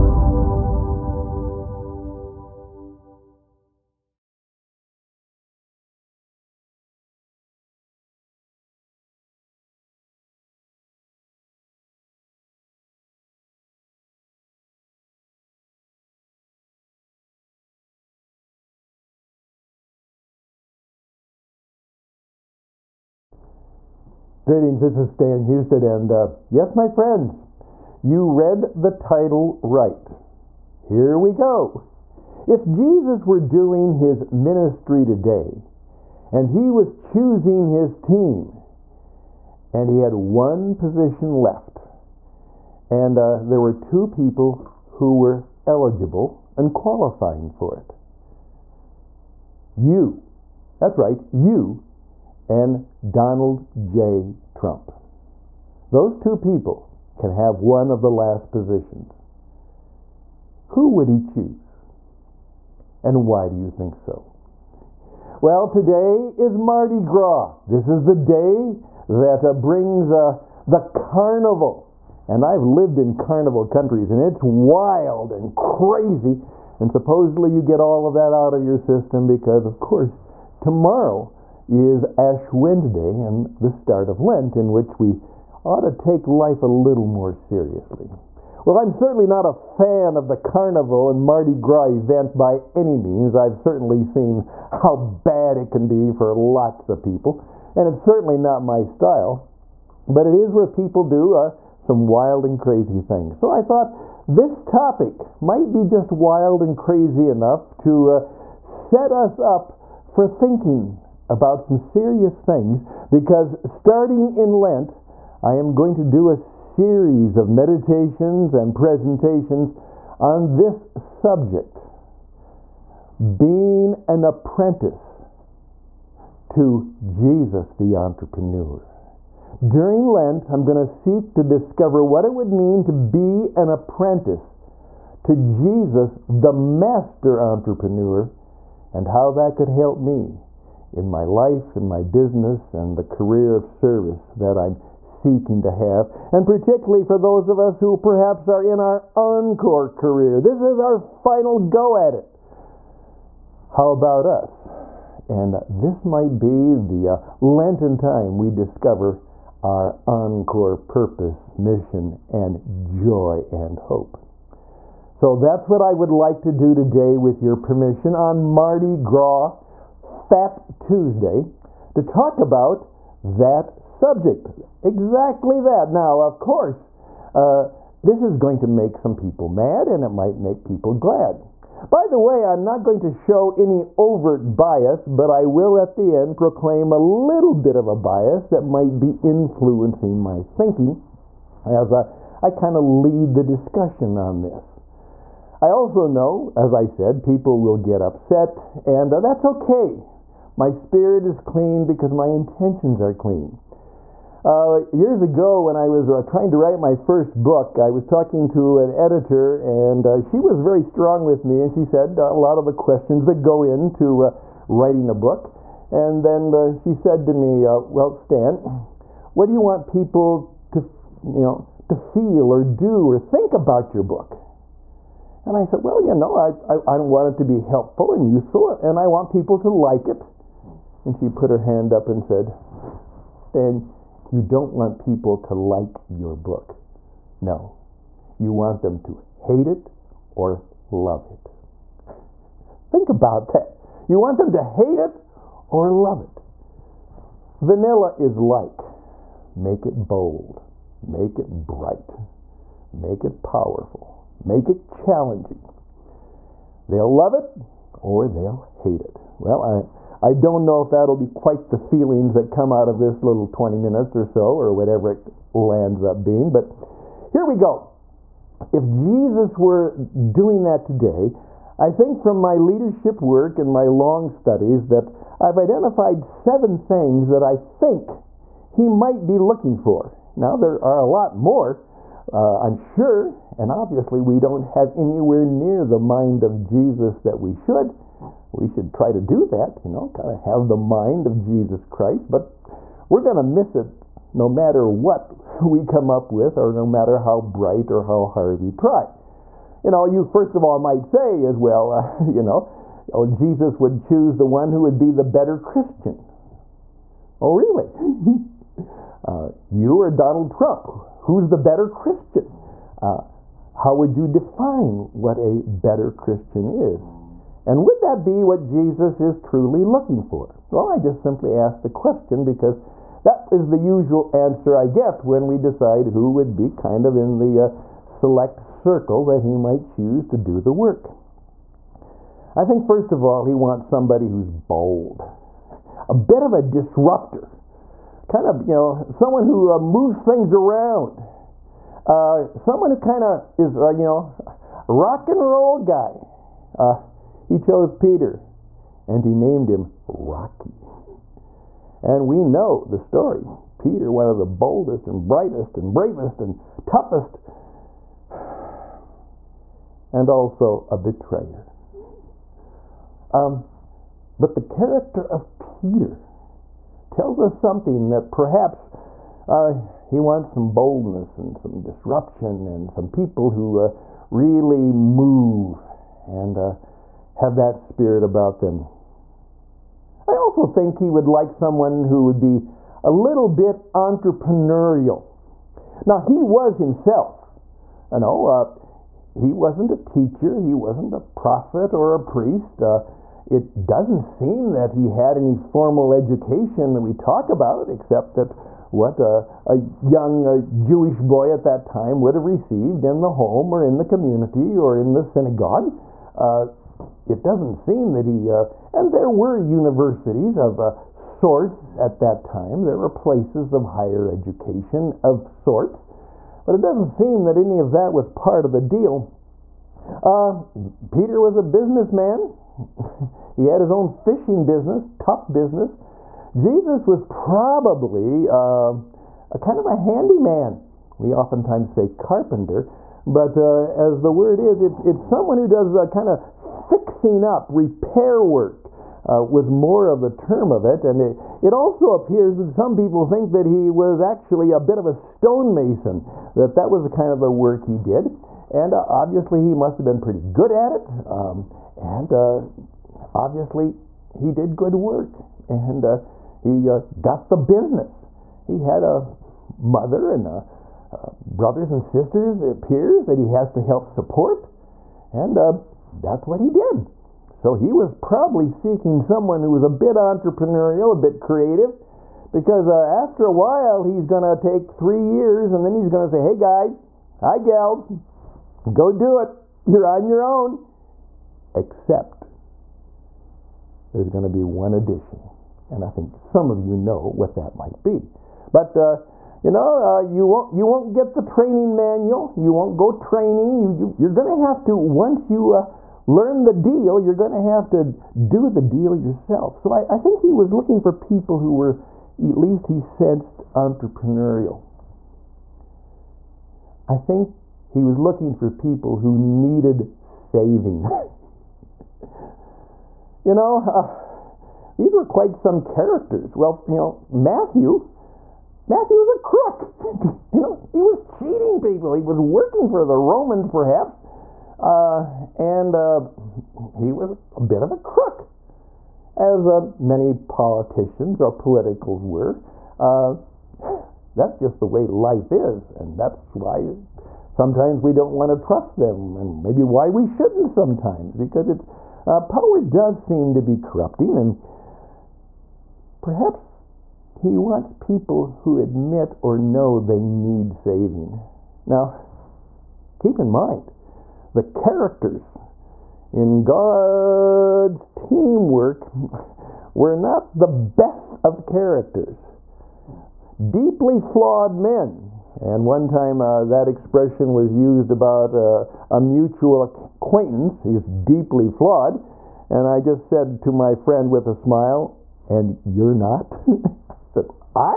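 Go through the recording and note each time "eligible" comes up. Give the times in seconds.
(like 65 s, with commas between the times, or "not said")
45 s.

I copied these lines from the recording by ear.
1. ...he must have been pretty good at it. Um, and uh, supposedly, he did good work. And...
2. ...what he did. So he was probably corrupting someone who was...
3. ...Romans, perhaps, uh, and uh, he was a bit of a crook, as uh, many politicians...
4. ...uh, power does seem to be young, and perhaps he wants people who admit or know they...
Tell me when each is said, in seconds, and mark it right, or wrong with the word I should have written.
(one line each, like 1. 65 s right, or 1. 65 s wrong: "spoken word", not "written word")
1. 449 s wrong: "obviously", not "supposedly"
2. 466 s wrong: "seeking", not "corrupting"
3. 523 s right
4. 542 s wrong: "corrupting", not "young".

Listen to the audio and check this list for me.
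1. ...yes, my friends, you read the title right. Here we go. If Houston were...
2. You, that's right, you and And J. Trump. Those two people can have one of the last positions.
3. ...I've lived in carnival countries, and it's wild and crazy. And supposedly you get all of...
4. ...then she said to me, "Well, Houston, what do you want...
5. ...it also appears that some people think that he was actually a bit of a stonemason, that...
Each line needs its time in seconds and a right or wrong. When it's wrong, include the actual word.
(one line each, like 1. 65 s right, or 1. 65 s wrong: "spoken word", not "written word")
1. 26 s wrong: "Jesus", not "Houston"
2. 49 s wrong: "Donald", not "And"
3. 72 s right
4. 216 s wrong: "Stan", not "Houston"
5. 441 s right.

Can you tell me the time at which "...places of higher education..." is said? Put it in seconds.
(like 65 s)
413 s.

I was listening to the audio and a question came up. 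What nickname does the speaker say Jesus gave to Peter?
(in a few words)
Rocky.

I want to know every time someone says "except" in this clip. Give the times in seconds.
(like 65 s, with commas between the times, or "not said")
397 s, 481 s.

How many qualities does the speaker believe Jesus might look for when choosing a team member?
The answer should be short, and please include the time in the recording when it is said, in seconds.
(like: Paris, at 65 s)
7, at 276 s.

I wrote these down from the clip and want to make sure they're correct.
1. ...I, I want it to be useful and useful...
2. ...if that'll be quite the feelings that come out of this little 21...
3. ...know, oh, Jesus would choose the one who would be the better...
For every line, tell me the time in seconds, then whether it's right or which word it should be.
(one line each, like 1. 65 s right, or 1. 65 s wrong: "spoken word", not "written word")
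1. 226 s wrong: "helpful", not "useful"
2. 260 s wrong: "20", not "21"
3. 302 s right.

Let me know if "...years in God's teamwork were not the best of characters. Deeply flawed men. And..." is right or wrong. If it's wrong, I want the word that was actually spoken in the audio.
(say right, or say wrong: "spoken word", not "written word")
wrong: "characters", not "years".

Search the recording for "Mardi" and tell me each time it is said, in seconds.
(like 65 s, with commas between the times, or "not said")
66 s, 91 s, 168 s.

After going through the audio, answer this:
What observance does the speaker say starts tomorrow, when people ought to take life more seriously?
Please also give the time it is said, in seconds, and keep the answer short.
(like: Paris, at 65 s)
Ash Wednesday, at 82 s.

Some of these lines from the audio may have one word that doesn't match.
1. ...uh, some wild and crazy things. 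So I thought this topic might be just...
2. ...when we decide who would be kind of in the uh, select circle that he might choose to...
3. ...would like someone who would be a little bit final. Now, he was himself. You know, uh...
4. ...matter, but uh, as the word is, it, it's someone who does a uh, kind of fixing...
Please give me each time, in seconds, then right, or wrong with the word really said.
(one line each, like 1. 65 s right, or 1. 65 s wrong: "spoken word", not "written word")
1. 101 s right
2. 325 s right
3. 381 s wrong: "entrepreneurial", not "final"
4. 432 s wrong: "carpenter", not "matter".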